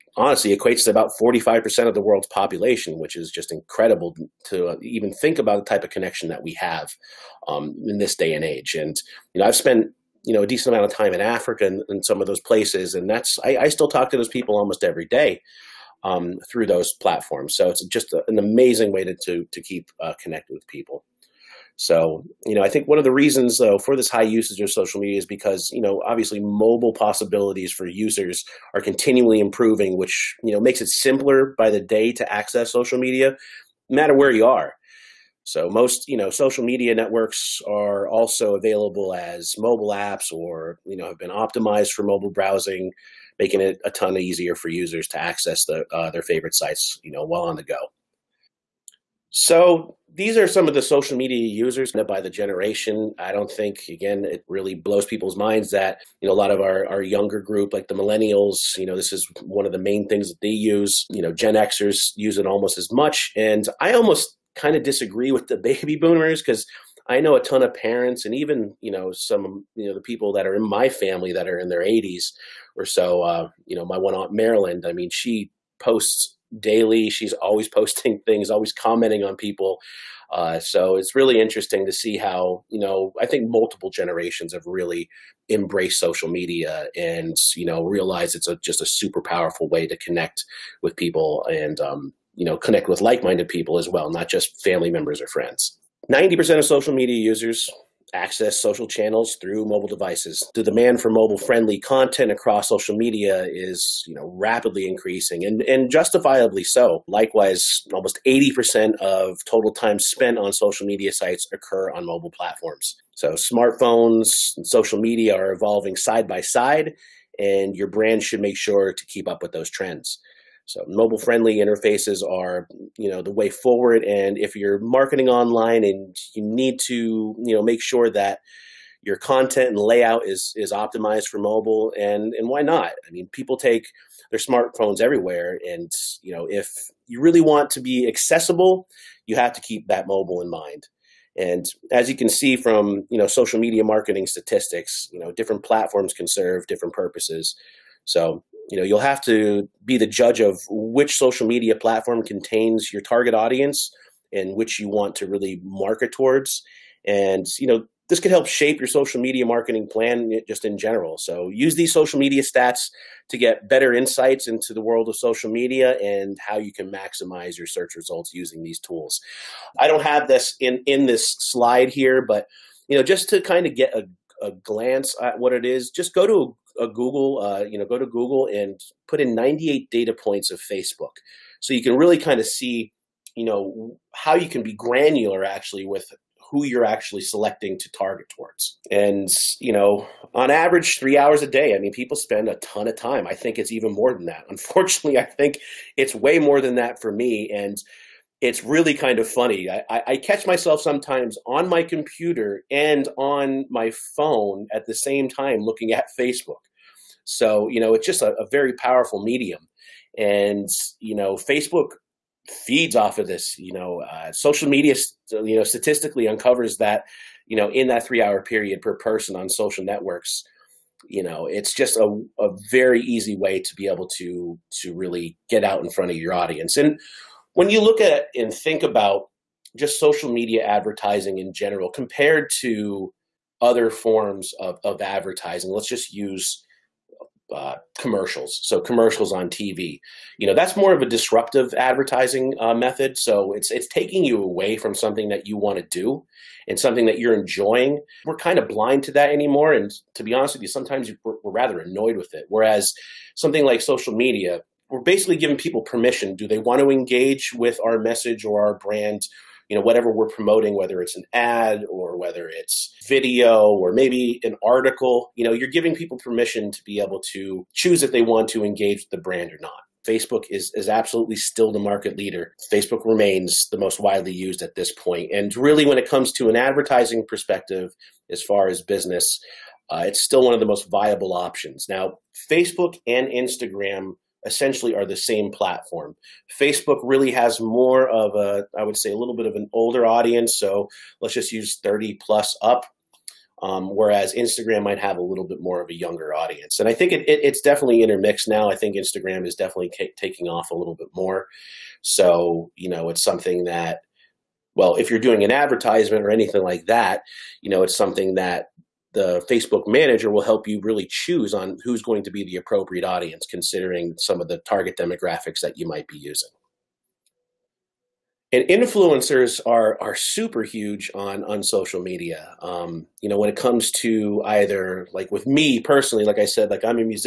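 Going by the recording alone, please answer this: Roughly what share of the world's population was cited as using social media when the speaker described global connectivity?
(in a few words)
45%.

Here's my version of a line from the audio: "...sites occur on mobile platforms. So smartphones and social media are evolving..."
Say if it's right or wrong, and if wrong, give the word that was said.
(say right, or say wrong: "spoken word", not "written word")
right.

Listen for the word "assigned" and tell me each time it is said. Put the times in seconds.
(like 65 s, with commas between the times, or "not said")
not said.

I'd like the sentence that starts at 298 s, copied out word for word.
I think Instagram is definitely taking off a little bit more.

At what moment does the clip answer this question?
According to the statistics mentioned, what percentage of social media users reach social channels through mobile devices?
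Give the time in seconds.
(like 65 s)
96 s.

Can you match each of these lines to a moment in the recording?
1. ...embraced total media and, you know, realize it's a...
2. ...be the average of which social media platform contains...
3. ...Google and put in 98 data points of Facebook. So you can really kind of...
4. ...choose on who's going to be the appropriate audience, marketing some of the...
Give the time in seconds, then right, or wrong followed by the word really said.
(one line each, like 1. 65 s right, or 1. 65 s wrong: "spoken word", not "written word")
1. 85 s wrong: "social", not "total"
2. 149 s wrong: "judge", not "average"
3. 178 s right
4. 311 s wrong: "considering", not "marketing".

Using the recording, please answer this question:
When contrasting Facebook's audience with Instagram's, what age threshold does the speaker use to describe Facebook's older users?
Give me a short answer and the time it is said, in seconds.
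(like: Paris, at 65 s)
30 plus, at 291 s.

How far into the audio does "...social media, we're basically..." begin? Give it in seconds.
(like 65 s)
253 s.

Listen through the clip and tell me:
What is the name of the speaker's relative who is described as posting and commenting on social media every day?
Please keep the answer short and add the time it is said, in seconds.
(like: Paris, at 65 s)
Marilyn, at 74 s.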